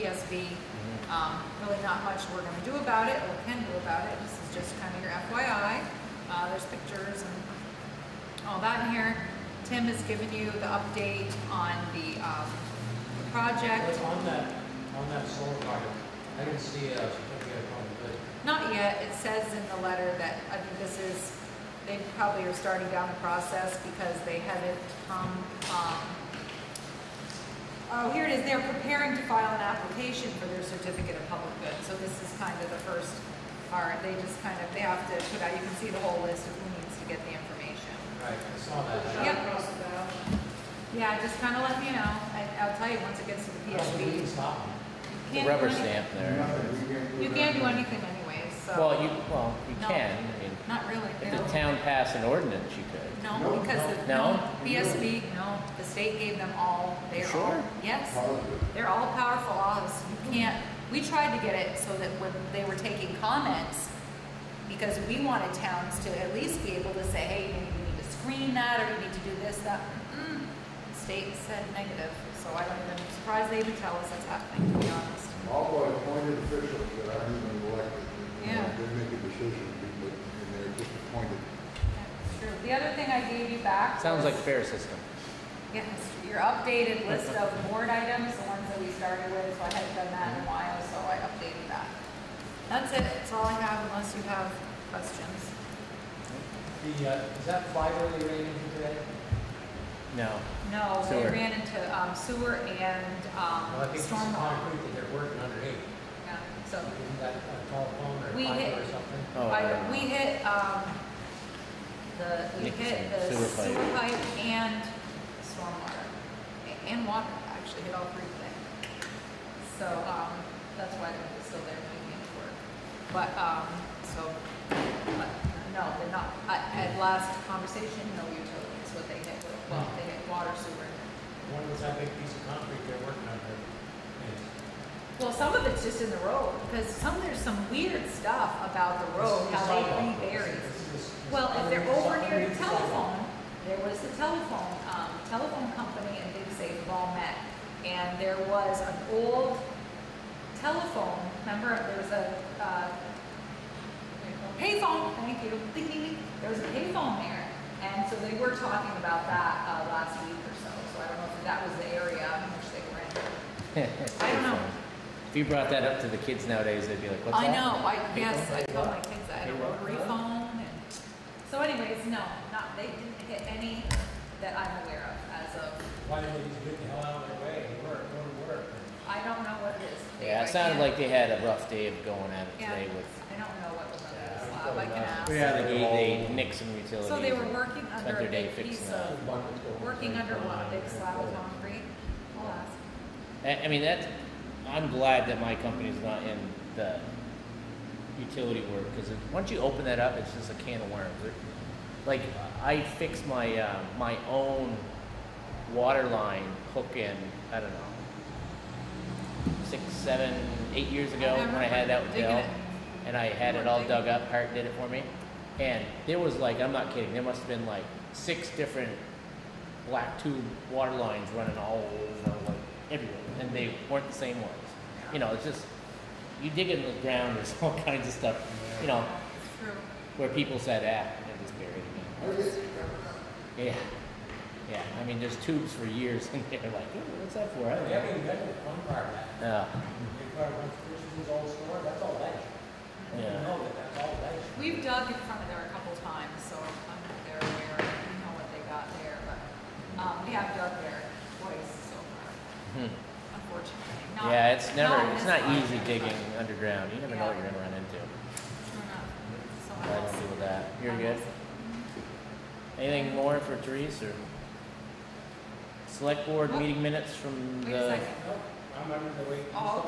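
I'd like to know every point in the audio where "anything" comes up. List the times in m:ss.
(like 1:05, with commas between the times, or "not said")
0:47, 4:22.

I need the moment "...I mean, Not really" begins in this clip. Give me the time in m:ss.
0:50.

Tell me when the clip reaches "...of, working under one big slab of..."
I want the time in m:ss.
3:08.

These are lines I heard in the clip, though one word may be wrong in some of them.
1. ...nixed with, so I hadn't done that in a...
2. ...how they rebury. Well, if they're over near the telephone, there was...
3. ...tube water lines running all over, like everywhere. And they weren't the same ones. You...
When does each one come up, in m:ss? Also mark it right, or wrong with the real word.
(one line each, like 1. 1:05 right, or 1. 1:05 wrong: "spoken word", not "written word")
1. 1:28 wrong: "started", not "nixed"
2. 2:19 right
3. 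3:40 right.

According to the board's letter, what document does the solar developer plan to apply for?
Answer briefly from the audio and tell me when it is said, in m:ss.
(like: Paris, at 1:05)
Certificate of public good, at 0:30.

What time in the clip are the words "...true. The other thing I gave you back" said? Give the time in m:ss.
1:22.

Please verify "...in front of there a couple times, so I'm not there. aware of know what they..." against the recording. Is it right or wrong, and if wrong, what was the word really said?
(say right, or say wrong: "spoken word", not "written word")
right.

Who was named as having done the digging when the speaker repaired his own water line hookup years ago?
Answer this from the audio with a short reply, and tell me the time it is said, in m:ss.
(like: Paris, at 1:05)
Hart, at 3:34.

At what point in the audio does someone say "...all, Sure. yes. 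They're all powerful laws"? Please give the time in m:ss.
0:57.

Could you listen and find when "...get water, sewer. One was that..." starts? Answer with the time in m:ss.
2:10.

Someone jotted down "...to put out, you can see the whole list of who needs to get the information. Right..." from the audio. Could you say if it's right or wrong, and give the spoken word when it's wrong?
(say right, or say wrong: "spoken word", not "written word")
right.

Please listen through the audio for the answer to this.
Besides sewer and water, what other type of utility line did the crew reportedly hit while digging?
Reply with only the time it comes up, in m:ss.
1:55.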